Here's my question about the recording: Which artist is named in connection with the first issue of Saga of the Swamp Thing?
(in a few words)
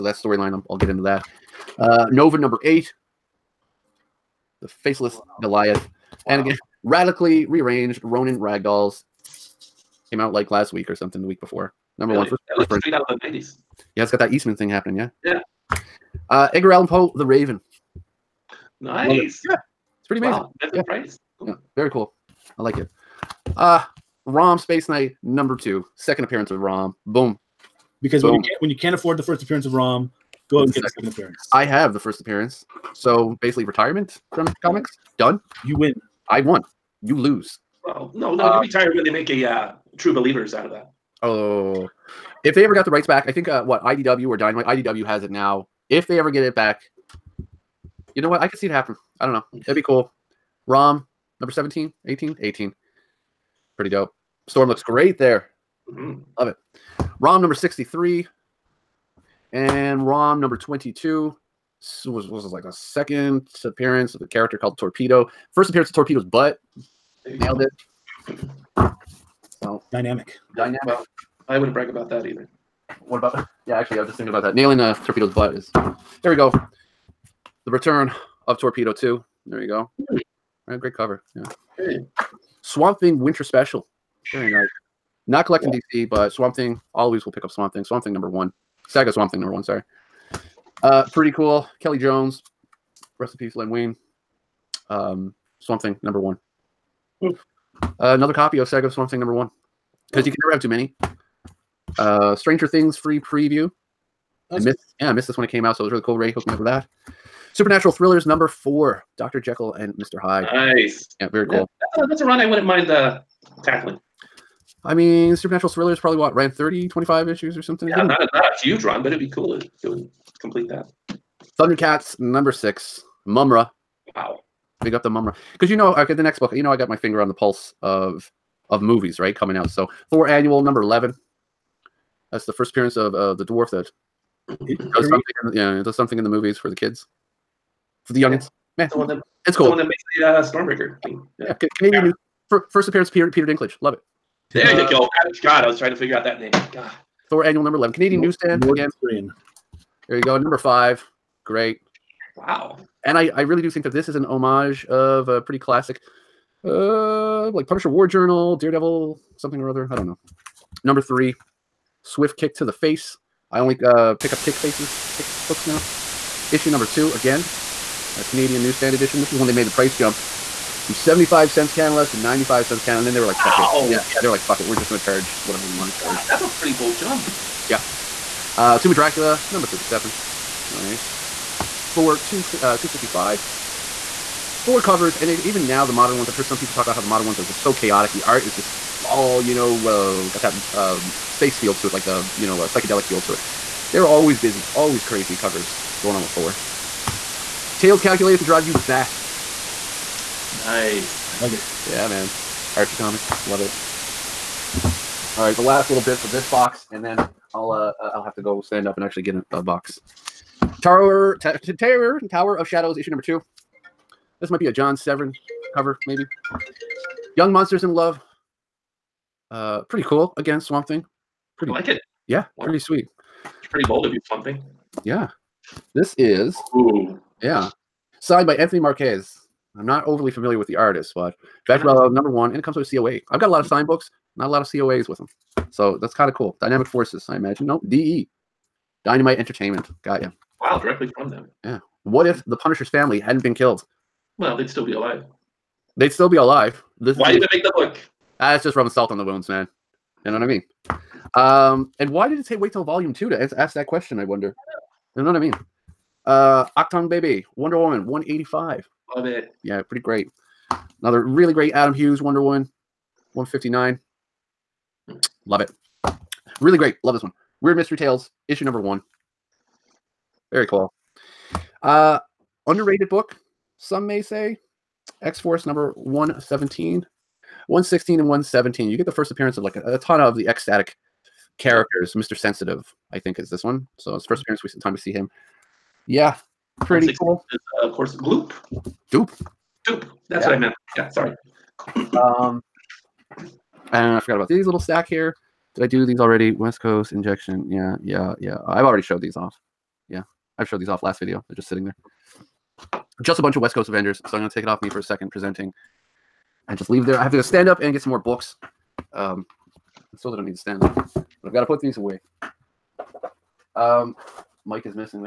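Kelly Jones.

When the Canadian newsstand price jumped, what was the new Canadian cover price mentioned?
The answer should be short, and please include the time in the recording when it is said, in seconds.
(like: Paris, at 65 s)
95 cents, at 172 s.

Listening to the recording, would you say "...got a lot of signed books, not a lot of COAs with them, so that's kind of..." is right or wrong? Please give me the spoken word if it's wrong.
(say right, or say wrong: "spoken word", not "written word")
right.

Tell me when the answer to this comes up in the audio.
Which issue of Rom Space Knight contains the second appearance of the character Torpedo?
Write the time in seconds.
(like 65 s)
60 s.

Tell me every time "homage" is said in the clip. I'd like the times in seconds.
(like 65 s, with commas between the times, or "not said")
154 s.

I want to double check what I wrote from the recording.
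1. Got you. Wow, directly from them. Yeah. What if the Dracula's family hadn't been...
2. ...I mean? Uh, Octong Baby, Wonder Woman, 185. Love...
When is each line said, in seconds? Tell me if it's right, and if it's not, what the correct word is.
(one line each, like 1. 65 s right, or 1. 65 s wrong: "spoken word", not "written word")
1. 240 s wrong: "Punisher", not "Dracula"
2. 255 s right.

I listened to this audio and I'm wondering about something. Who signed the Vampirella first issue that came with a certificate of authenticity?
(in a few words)
Anthony Marquez.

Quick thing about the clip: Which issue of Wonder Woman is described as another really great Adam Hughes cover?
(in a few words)
159.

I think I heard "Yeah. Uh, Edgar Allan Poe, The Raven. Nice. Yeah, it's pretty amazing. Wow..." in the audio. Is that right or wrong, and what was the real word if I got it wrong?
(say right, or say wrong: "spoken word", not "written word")
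right.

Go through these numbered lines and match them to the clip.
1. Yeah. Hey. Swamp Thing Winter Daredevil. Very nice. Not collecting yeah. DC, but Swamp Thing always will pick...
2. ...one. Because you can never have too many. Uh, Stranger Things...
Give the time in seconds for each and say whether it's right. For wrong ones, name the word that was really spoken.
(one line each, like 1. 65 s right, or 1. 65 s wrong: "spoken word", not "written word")
1. 81 s wrong: "Special", not "Daredevil"
2. 99 s right.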